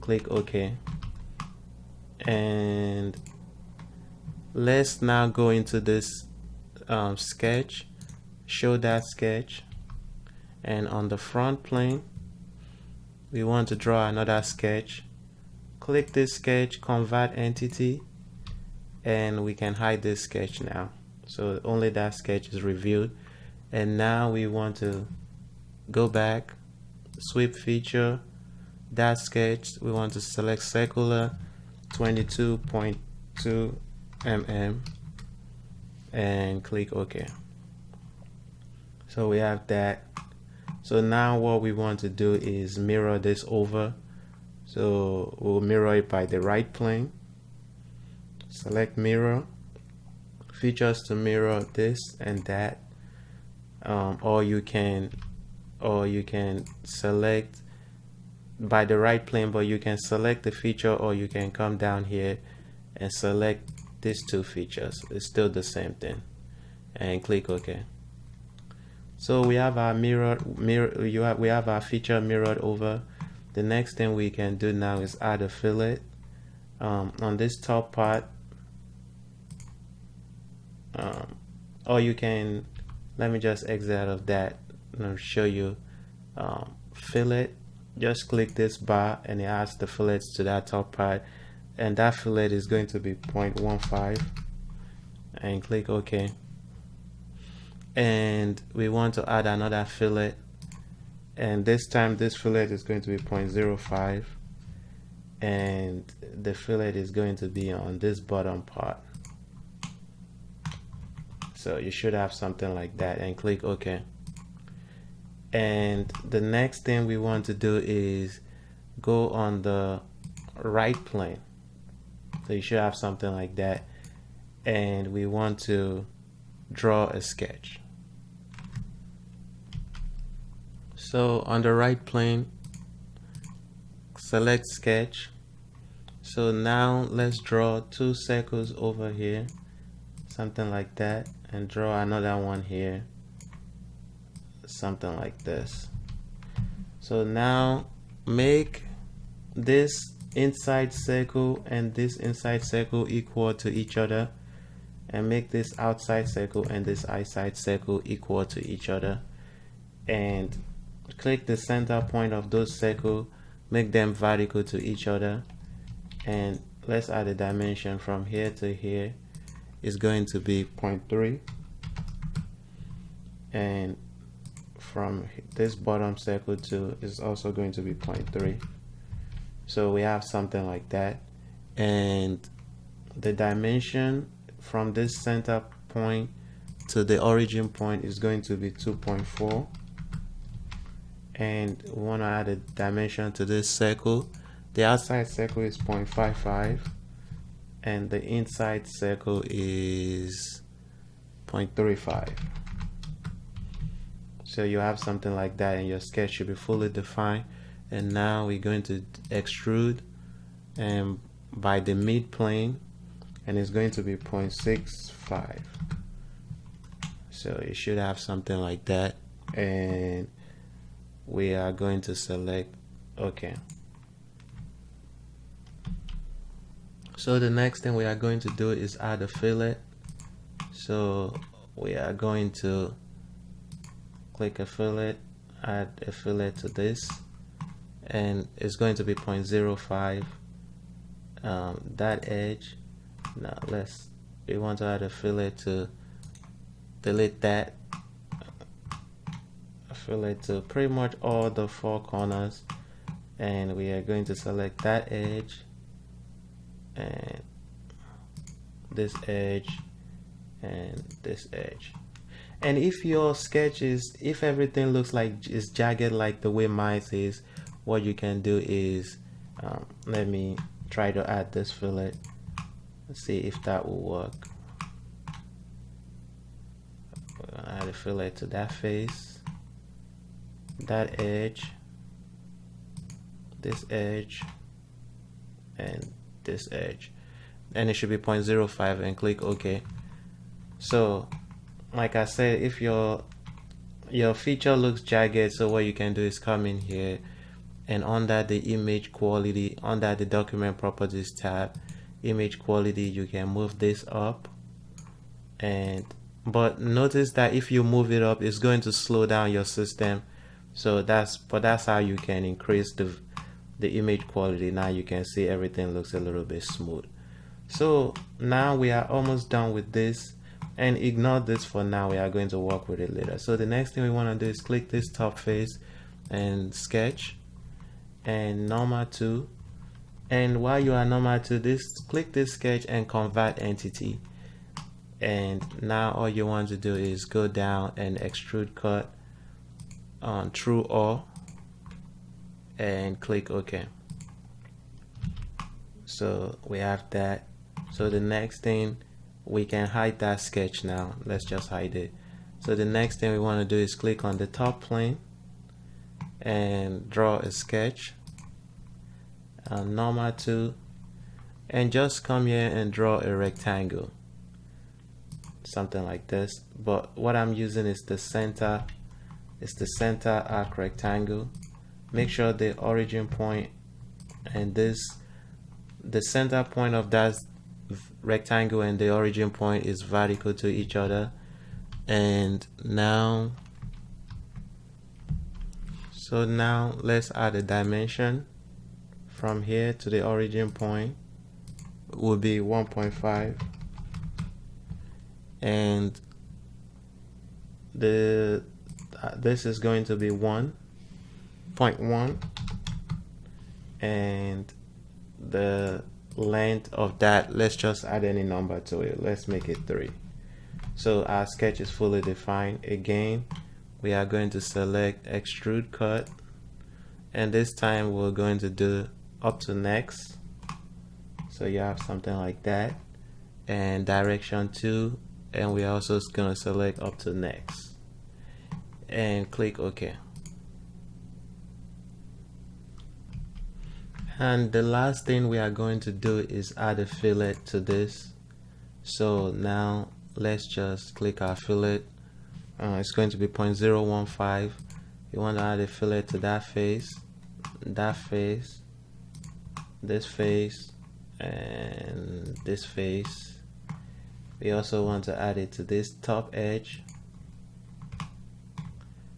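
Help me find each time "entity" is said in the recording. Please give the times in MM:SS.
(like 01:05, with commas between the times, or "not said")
00:17, 05:33.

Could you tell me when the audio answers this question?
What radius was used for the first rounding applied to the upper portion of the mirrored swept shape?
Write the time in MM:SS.
01:33.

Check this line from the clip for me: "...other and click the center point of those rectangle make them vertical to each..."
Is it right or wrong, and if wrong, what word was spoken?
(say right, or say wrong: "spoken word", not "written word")
wrong: "circle", not "rectangle".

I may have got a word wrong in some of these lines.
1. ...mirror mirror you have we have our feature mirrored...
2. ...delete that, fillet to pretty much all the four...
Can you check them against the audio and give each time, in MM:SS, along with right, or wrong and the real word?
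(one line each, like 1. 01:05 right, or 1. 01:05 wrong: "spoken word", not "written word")
1. 01:09 right
2. 04:07 right.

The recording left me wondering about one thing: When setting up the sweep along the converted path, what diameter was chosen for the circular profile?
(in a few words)
22.2 mm.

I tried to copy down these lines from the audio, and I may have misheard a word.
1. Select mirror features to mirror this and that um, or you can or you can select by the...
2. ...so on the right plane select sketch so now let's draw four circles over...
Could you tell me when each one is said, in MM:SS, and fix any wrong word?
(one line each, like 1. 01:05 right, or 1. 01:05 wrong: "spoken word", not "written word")
1. 00:48 right
2. 02:10 wrong: "two", not "four".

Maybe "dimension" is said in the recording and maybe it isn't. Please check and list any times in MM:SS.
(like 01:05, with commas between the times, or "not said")
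02:47, 03:03, 03:12, 06:27.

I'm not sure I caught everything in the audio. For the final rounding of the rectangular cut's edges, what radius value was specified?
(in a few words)
0.015.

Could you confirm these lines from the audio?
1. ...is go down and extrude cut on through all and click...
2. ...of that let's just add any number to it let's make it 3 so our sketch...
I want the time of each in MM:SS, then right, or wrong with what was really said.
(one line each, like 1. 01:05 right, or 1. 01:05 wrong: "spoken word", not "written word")
1. 05:36 right
2. 06:46 right.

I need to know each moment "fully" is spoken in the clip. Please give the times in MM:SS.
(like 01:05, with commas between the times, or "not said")
03:26, 06:51.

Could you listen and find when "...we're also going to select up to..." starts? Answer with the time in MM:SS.
07:05.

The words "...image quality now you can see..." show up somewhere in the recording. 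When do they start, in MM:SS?
05:13.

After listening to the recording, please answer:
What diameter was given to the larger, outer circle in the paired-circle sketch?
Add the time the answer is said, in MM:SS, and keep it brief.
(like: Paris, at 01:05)
0.55, at 03:15.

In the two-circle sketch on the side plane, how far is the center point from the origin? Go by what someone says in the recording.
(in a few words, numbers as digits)
2.4.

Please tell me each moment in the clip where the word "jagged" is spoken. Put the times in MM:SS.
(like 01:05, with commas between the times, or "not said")
04:25, 04:55.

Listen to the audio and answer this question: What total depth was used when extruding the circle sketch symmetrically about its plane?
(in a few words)
0.65.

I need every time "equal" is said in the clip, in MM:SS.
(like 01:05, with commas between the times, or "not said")
02:33, 02:38.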